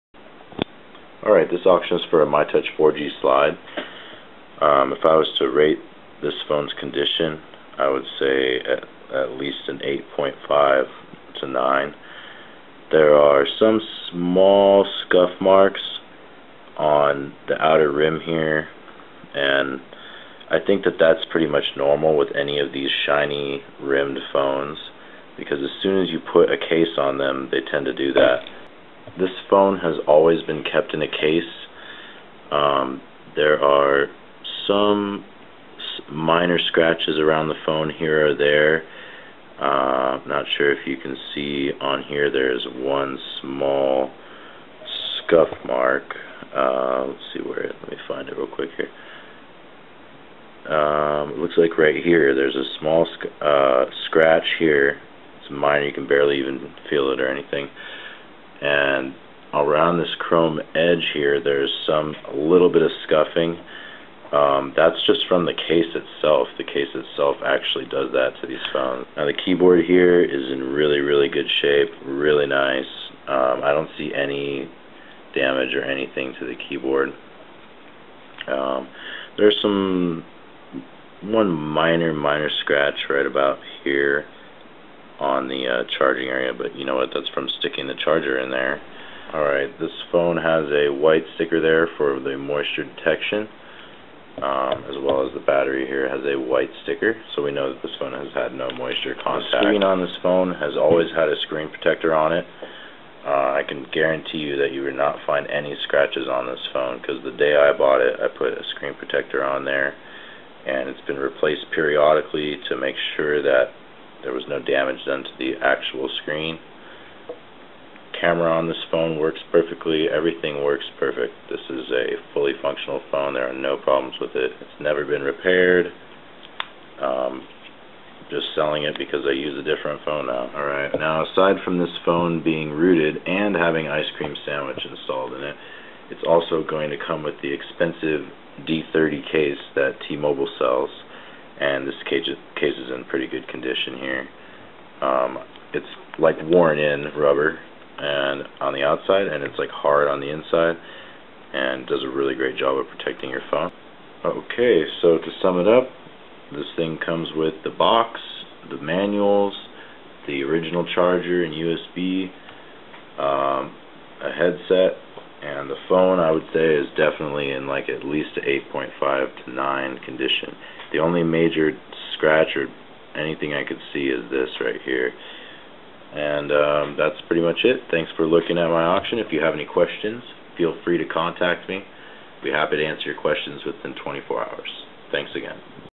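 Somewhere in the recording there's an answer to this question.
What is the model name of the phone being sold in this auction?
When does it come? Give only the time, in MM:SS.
00:02.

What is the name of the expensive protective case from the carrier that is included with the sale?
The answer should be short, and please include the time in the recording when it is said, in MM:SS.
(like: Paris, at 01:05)
D3O, at 02:18.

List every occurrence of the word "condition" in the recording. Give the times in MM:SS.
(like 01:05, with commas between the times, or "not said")
00:06, 02:23, 02:50.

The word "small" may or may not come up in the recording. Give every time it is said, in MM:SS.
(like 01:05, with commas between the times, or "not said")
00:14, 00:43, 00:52.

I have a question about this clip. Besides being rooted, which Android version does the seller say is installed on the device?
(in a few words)
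Ice Cream Sandwich.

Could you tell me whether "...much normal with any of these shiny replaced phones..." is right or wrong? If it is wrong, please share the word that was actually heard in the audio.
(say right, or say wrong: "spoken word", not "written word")
wrong: "rimmed", not "replaced".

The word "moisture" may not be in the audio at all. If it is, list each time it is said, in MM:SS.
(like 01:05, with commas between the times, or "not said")
01:32, 01:38.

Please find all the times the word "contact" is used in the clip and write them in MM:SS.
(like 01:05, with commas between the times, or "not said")
01:39, 03:01.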